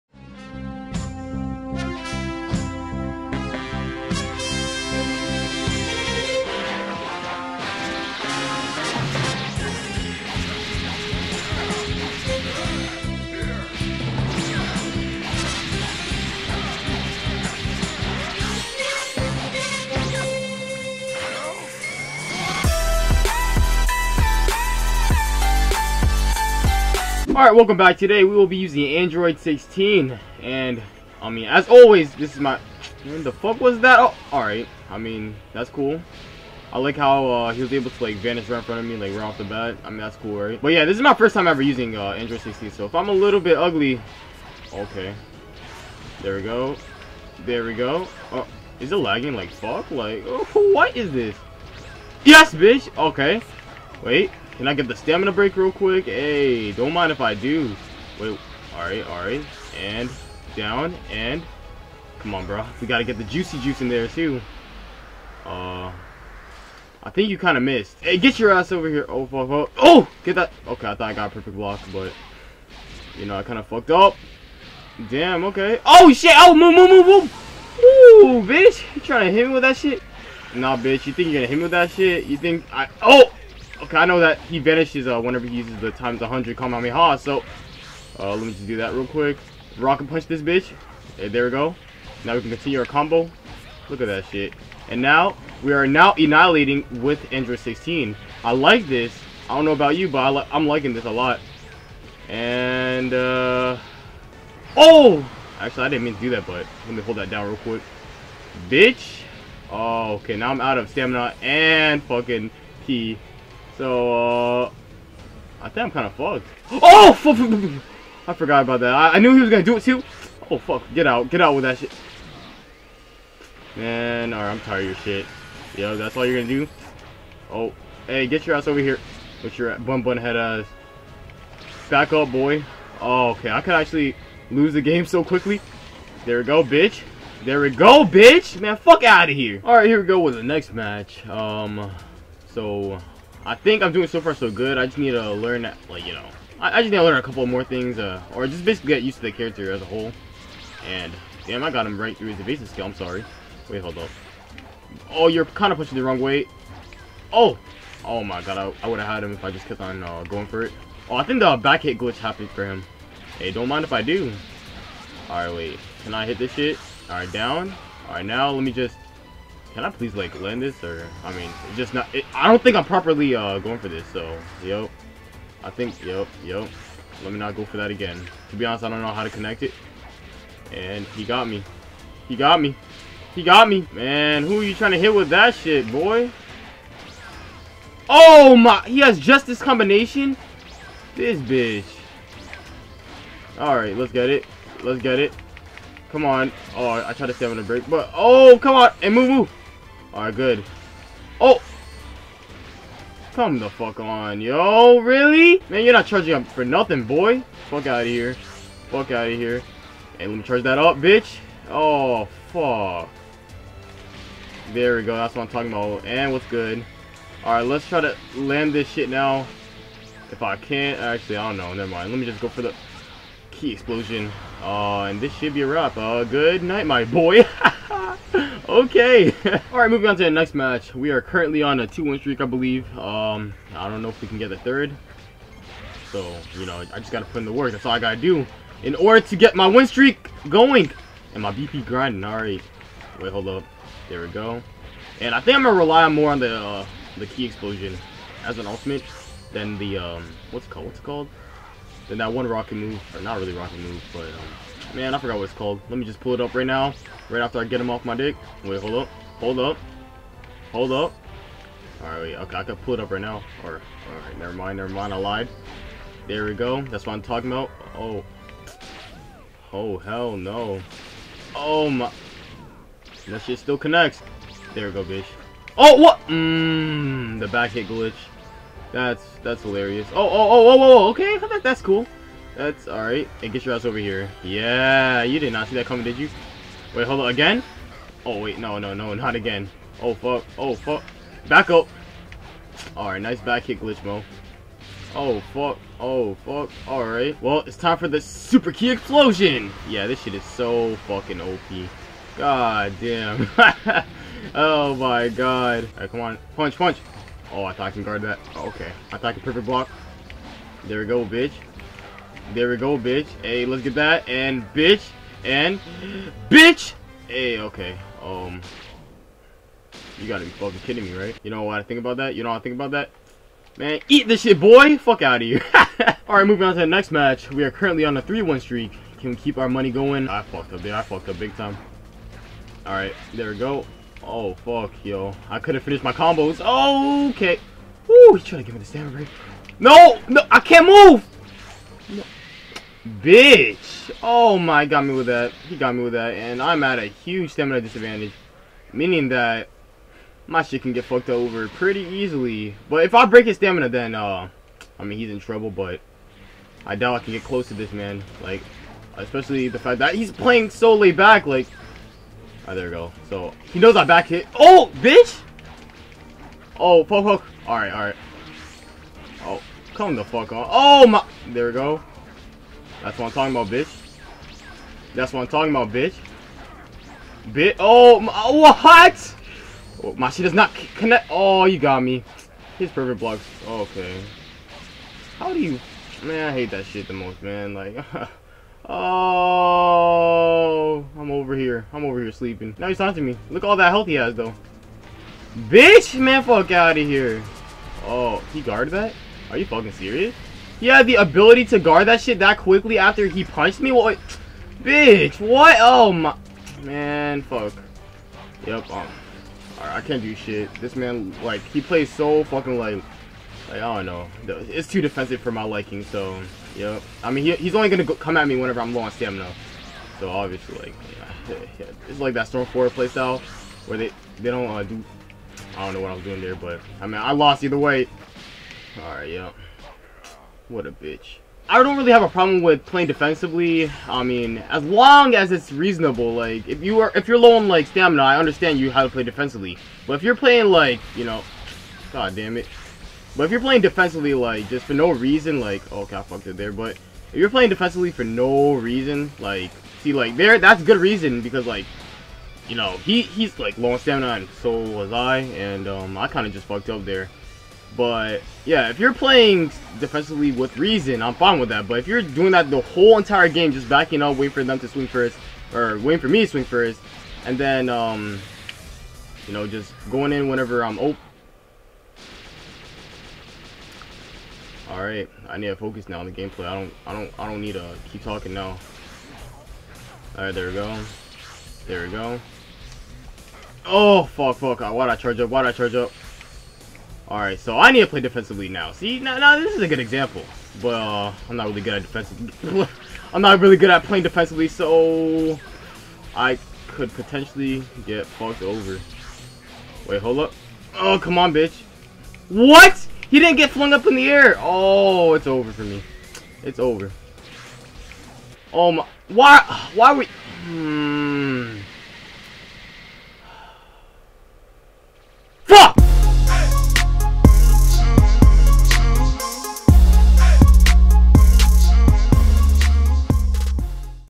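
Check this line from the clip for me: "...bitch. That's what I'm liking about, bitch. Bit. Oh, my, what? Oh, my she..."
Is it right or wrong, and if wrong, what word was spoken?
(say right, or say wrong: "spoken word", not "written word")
wrong: "talking", not "liking".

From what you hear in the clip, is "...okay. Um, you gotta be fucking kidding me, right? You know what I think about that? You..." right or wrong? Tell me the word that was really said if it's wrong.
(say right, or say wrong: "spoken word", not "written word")
right.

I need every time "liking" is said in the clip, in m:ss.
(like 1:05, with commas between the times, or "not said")
1:40, 6:55.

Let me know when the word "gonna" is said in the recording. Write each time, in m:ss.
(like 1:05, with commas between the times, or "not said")
1:21, 1:59, 2:06, 4:05.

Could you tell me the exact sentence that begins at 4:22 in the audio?
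All right, wait, okay, I can pull it up right now.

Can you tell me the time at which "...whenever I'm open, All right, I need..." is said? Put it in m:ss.
7:50.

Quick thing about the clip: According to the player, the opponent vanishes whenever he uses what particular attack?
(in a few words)
times 100 Kamehameha.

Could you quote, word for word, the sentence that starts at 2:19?
All right, here we go with the next match.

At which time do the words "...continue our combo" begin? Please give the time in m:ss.
1:32.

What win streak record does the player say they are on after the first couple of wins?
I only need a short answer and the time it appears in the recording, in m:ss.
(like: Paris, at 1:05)
2-1, at 3:51.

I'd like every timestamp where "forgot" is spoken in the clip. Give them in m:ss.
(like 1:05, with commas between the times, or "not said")
1:58, 4:15.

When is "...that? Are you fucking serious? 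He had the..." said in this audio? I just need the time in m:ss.
6:38.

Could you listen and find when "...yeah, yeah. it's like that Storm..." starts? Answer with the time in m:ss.
7:01.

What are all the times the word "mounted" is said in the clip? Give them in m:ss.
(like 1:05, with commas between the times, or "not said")
not said.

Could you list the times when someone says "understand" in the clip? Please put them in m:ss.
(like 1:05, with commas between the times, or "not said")
7:18.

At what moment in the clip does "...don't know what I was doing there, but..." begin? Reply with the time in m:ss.
7:05.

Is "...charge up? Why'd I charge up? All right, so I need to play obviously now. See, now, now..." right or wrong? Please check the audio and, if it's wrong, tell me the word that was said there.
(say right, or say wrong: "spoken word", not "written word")
wrong: "defensively", not "obviously".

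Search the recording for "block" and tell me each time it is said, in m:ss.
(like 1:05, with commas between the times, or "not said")
1:11, 5:09, 6:23.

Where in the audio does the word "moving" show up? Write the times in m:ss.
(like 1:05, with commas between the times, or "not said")
3:49, 5:26.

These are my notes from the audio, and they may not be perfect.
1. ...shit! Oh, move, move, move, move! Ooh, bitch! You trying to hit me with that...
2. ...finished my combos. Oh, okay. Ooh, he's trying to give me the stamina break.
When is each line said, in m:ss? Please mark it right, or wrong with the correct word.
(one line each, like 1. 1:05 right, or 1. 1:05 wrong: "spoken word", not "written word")
1. 1:16 right
2. 5:35 right.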